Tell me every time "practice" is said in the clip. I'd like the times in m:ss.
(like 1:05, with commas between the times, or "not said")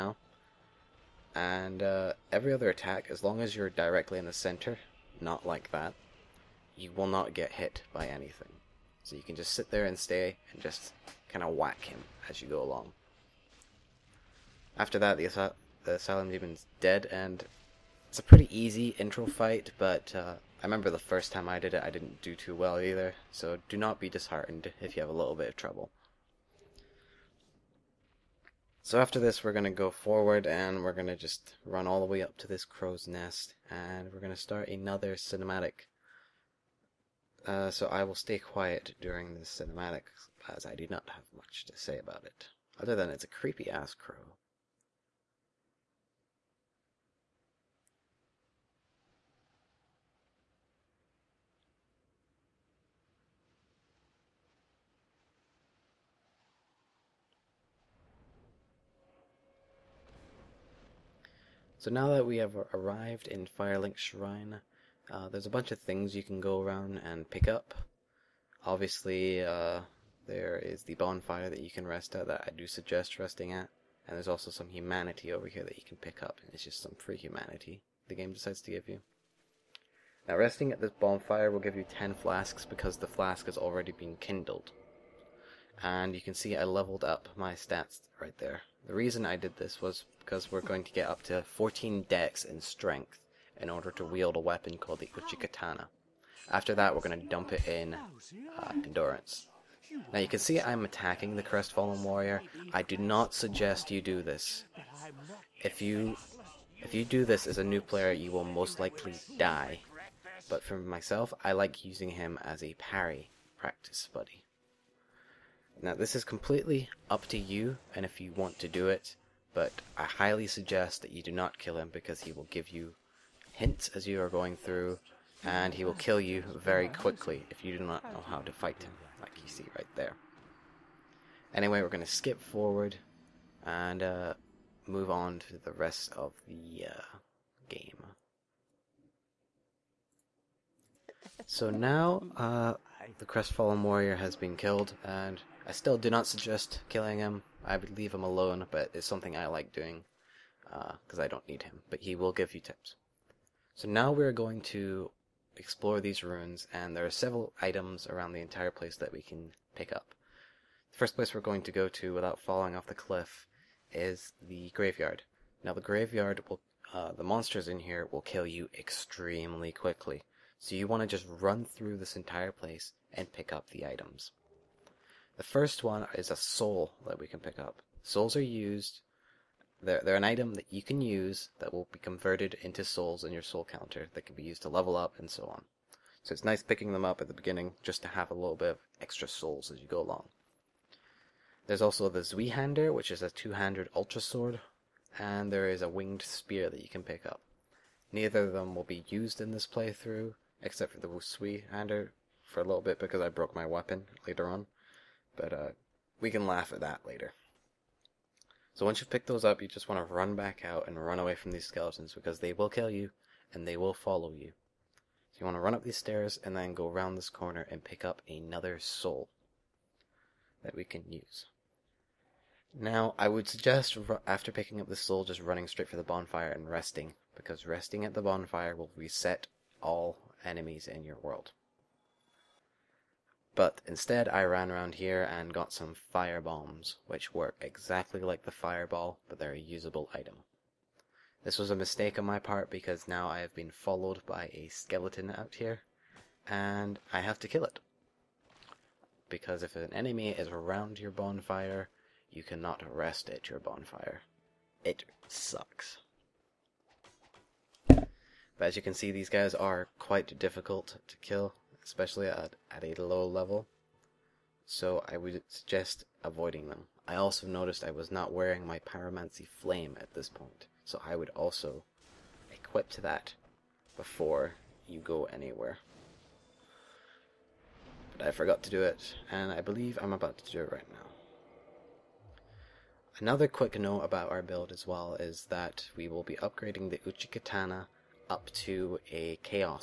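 1:53.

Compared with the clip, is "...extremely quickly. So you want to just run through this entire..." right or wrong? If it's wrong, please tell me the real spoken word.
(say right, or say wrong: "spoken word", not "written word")
right.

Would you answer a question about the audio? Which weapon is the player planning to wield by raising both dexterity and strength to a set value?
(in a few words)
Uchikatana.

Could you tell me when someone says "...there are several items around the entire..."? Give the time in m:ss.
2:36.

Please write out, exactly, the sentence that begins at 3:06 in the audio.
So it's nice picking them up at the beginning just to have a little bit of extra souls as you go along.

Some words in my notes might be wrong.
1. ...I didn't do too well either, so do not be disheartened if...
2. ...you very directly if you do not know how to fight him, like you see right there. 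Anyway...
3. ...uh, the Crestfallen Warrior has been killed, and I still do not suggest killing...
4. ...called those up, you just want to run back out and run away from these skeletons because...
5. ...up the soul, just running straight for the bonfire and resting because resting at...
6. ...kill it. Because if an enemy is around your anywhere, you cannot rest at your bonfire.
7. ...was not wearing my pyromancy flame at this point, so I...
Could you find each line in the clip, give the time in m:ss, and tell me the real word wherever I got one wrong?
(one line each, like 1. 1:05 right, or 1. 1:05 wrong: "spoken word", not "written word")
1. 0:21 right
2. 2:06 wrong: "quickly", not "directly"
3. 2:22 right
4. 3:29 wrong: "picked", not "called"
5. 3:44 right
6. 4:07 wrong: "bonfire", not "anywhere"
7. 4:27 right.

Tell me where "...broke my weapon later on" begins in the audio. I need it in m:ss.
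3:23.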